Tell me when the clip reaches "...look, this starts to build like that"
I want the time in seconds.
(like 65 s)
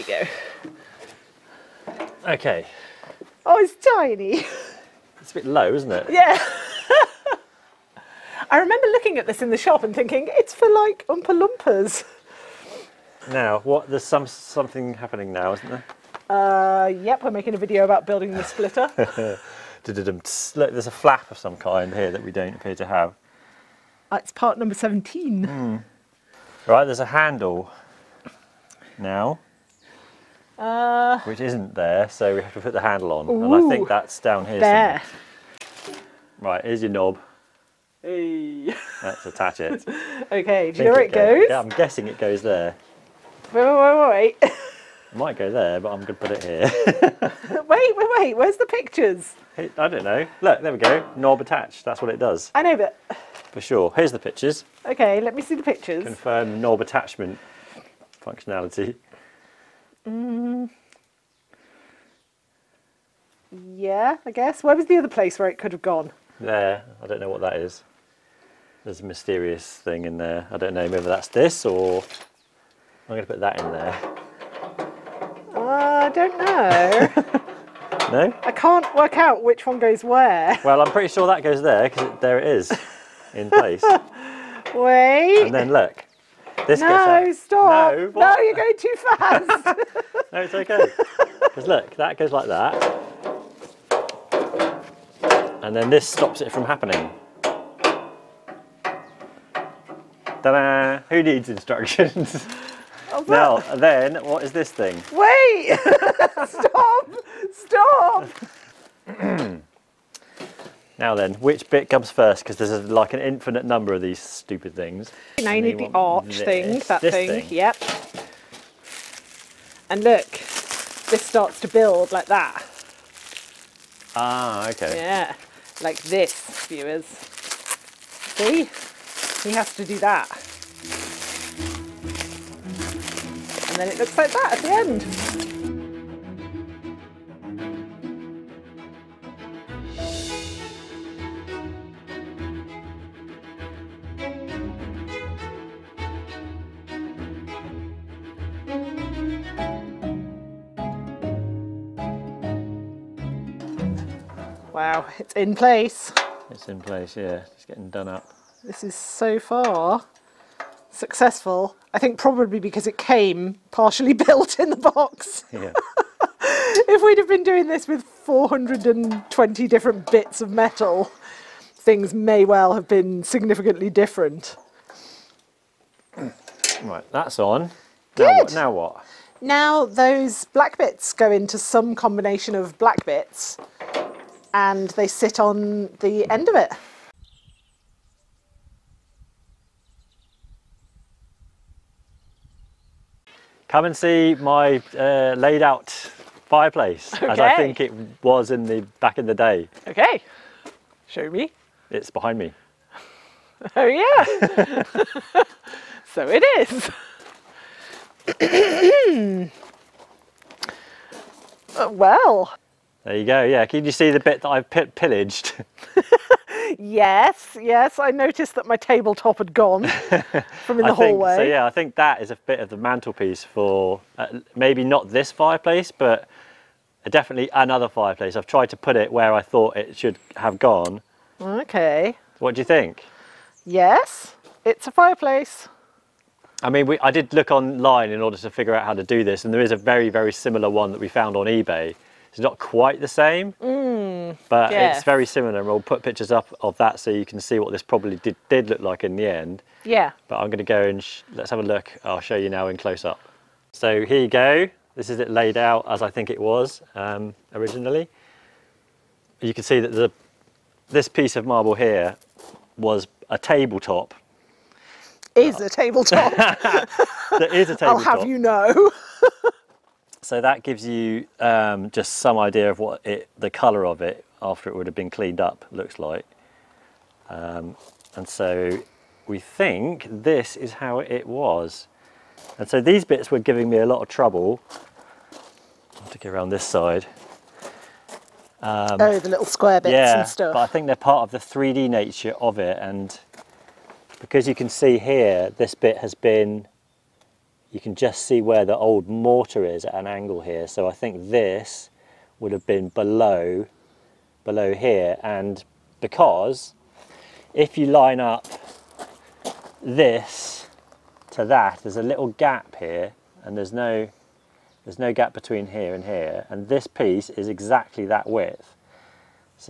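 120 s.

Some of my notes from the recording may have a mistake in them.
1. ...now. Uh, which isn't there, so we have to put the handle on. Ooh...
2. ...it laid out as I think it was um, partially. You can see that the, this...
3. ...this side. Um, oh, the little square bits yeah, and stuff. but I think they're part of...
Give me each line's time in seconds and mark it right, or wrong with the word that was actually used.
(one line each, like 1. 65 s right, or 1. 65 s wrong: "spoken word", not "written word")
1. 28 s right
2. 255 s wrong: "originally", not "partially"
3. 286 s right.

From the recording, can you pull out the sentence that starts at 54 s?
Okay, let me see the pictures.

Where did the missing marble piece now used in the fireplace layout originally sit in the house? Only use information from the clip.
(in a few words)
in the hallway.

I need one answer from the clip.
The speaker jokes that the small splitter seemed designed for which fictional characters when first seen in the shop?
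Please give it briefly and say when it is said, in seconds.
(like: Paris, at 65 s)
Oompa Loompas, at 11 s.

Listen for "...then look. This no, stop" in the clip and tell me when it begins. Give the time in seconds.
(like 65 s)
85 s.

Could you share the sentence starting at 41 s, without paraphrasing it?
Yeah, I'm guessing it goes there.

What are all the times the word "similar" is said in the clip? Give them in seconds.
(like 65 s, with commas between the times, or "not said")
240 s, 245 s.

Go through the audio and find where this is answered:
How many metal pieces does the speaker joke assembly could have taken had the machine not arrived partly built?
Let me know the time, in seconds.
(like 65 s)
168 s.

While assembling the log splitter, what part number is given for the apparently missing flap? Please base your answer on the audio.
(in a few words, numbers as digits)
17.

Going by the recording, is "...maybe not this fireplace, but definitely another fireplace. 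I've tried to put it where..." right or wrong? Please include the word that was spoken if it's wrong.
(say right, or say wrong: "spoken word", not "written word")
right.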